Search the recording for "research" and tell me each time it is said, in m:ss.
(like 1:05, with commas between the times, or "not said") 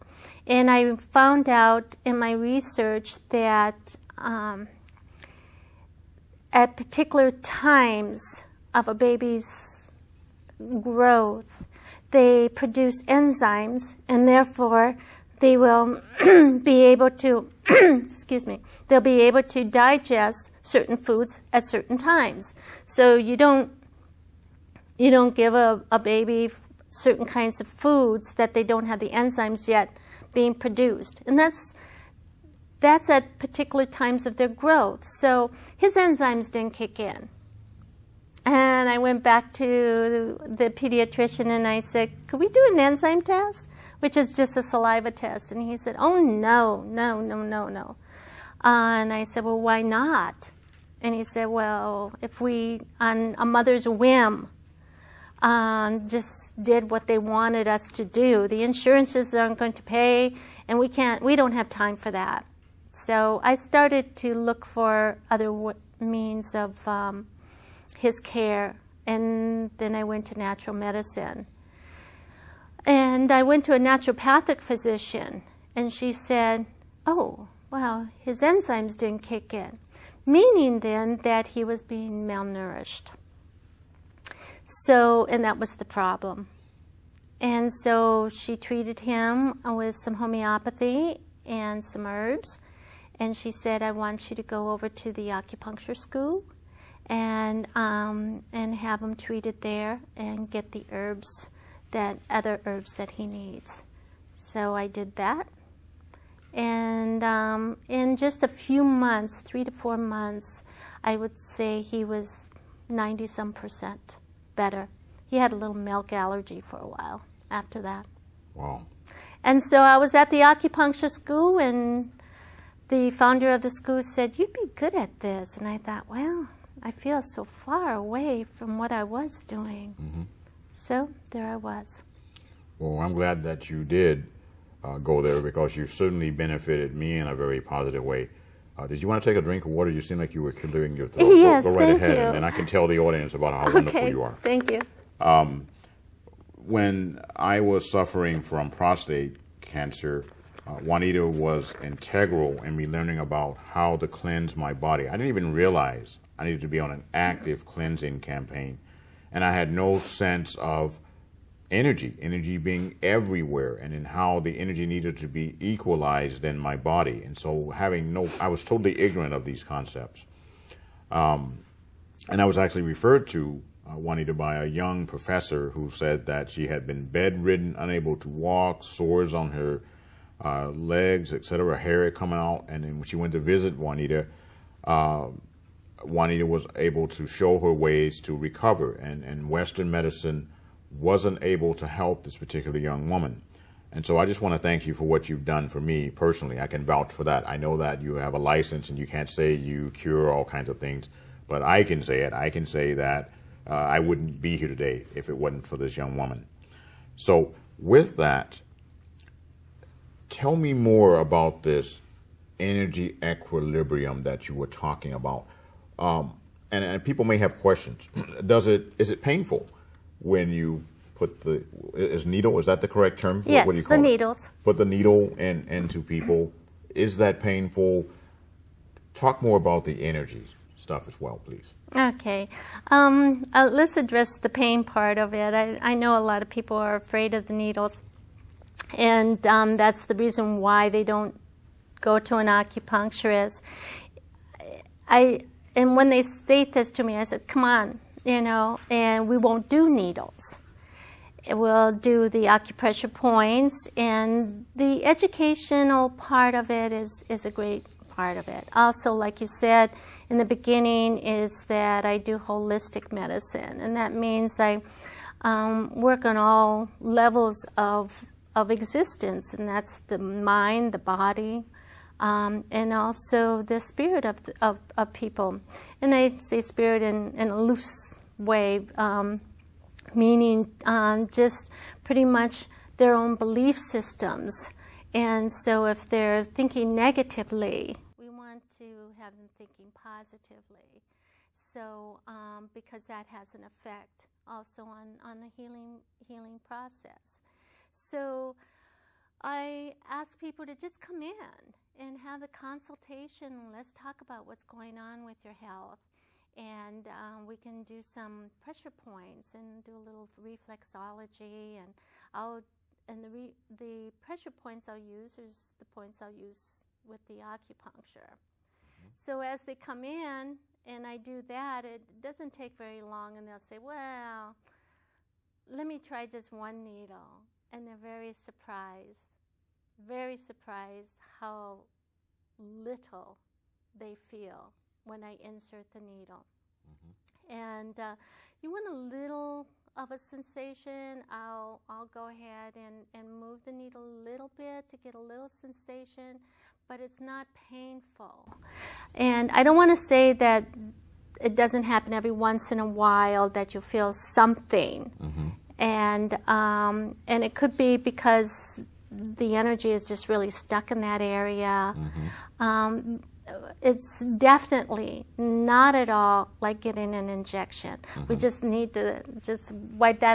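0:02.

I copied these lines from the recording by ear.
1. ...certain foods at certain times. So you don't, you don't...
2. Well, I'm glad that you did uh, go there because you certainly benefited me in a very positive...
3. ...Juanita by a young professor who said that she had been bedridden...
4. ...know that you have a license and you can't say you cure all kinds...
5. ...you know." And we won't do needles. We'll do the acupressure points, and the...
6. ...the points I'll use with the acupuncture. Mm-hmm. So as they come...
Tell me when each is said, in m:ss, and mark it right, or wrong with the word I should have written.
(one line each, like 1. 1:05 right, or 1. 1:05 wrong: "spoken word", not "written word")
1. 0:20 right
2. 2:12 right
3. 2:53 right
4. 3:17 right
5. 4:08 right
6. 5:15 right.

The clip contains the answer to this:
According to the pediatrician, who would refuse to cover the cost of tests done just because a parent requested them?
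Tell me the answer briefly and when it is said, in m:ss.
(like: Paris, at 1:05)
The insurances, at 0:58.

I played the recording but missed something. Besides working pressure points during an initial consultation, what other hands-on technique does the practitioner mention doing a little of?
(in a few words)
reflexology.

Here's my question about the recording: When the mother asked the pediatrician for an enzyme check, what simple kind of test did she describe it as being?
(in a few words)
saliva test.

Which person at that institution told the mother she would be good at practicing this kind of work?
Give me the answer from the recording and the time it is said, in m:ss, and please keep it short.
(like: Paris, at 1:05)
the founder of the school, at 2:02.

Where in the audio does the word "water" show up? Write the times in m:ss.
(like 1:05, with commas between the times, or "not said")
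2:19.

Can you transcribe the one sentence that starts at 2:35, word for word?
I didn't even realize I needed to be on an active cleansing campaign.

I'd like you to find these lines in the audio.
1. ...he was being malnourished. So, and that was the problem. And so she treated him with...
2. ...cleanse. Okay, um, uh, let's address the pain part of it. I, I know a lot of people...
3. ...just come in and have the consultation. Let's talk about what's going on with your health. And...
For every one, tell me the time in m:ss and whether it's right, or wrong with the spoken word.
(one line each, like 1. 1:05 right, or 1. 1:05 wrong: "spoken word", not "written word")
1. 1:21 right
2. 3:51 wrong: "please", not "cleanse"
3. 5:00 right.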